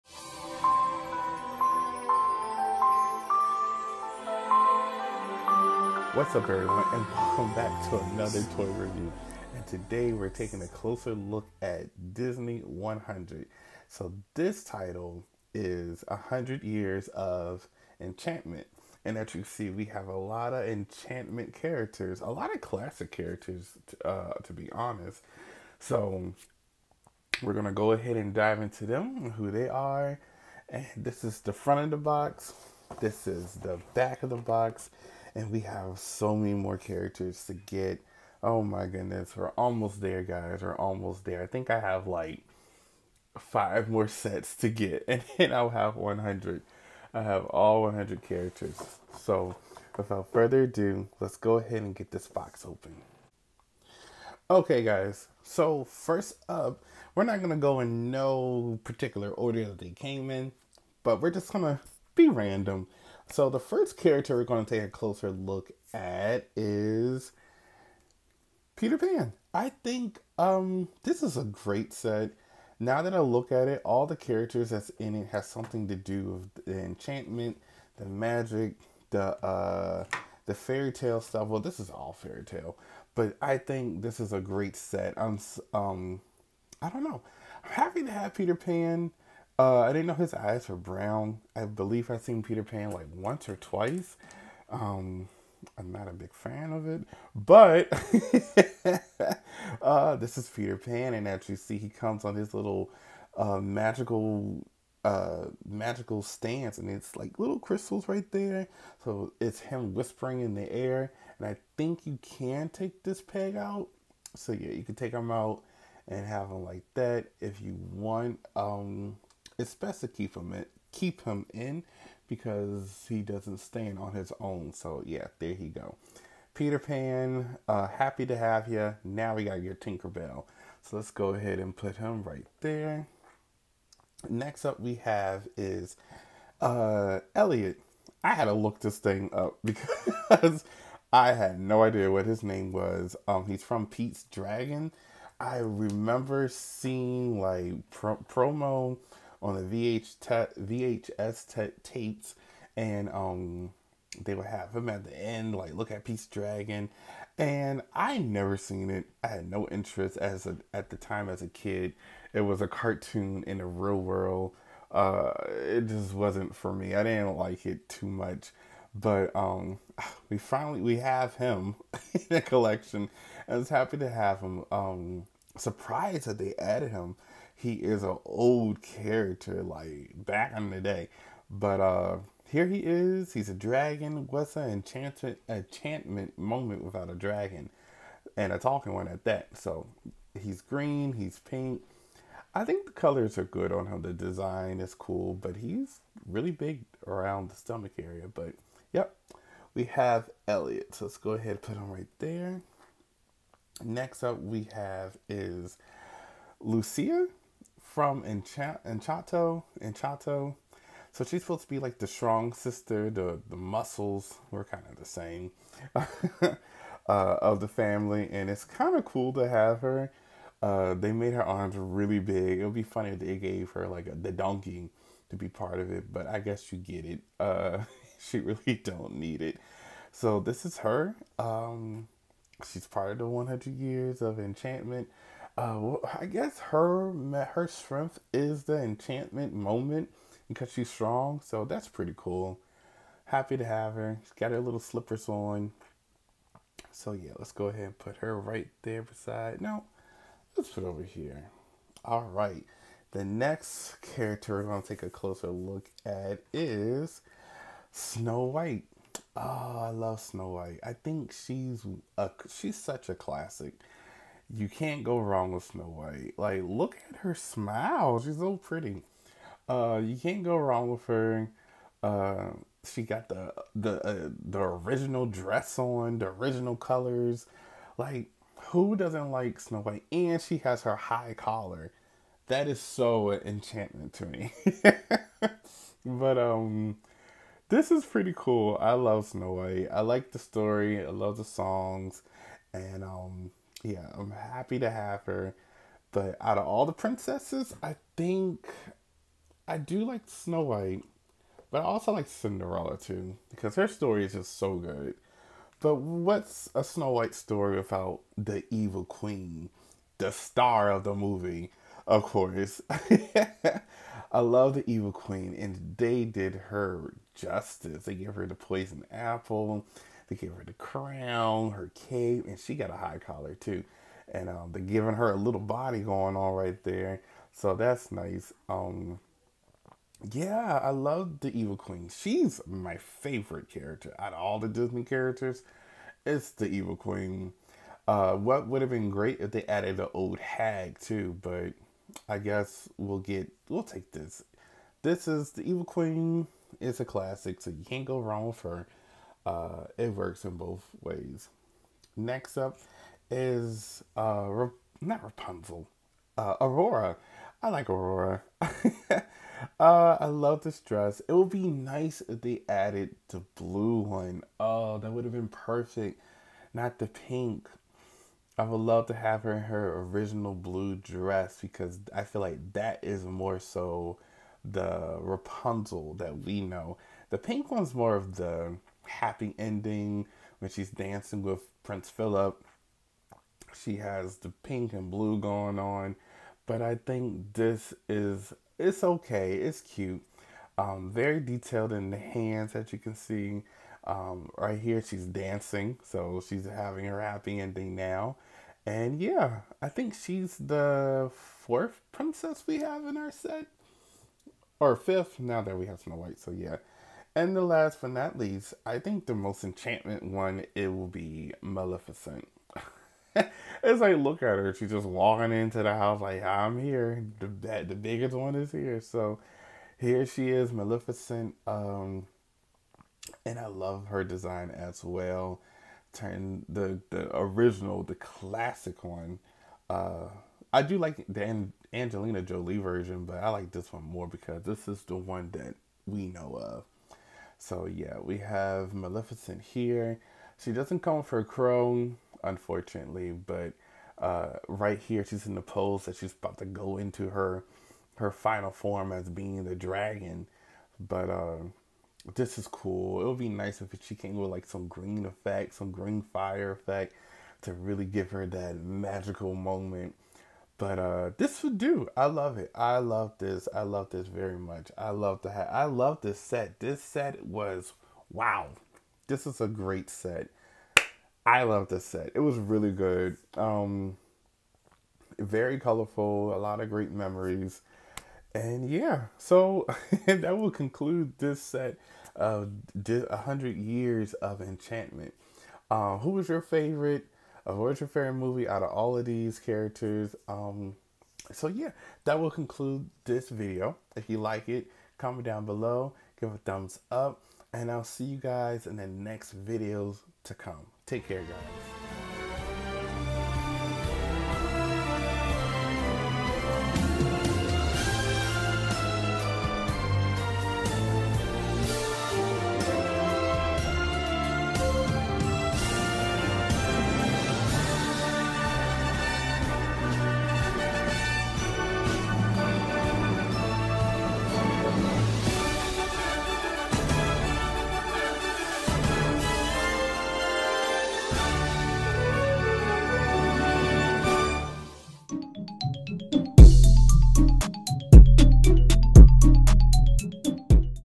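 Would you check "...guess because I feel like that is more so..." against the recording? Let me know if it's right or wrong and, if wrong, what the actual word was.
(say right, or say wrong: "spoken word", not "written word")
wrong: "dress", not "guess".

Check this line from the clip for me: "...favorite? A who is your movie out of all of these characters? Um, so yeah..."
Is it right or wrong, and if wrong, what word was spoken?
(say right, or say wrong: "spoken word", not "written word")
right.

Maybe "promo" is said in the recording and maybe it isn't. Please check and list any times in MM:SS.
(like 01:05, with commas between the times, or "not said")
02:28.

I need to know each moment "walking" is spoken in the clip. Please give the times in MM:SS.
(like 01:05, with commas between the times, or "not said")
06:55.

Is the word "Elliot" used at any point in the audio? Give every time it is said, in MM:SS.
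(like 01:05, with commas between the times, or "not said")
02:17, 03:20.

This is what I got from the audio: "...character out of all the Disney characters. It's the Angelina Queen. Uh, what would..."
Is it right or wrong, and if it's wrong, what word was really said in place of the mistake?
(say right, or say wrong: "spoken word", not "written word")
wrong: "Evil", not "Angelina".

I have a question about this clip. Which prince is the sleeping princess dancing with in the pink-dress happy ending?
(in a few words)
Prince Philip.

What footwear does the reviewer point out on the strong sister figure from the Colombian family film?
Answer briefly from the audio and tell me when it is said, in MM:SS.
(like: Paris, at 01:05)
Slippers, at 04:04.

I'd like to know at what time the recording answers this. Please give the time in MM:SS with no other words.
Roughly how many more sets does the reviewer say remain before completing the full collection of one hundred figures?
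00:43.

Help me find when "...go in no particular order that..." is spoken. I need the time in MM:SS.
00:57.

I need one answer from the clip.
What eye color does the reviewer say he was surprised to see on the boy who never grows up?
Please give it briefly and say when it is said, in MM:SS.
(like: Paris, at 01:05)
Brown, at 01:30.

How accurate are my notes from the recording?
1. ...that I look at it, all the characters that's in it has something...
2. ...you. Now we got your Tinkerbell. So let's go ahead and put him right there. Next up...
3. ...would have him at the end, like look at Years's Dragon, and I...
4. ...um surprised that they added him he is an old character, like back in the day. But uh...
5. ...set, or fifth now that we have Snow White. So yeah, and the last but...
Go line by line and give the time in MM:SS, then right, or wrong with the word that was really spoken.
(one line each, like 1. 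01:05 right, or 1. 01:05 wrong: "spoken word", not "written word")
1. 01:13 right
2. 02:08 right
3. 02:34 wrong: "Pete", not "Years"
4. 02:54 right
5. 06:43 right.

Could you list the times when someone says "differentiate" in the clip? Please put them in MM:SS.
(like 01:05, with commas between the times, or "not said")
not said.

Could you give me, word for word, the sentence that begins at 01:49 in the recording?
So it's him whispering in the air, and I think you can take this peg out.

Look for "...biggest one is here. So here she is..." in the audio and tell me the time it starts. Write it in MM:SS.
06:57.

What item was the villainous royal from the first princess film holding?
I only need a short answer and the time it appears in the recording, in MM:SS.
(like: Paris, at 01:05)
Poison apple, at 05:18.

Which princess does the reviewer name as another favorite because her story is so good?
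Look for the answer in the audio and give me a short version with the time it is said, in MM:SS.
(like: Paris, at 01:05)
Cinderella, at 05:02.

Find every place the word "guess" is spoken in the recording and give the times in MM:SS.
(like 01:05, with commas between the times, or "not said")
03:46, 03:56, 05:42.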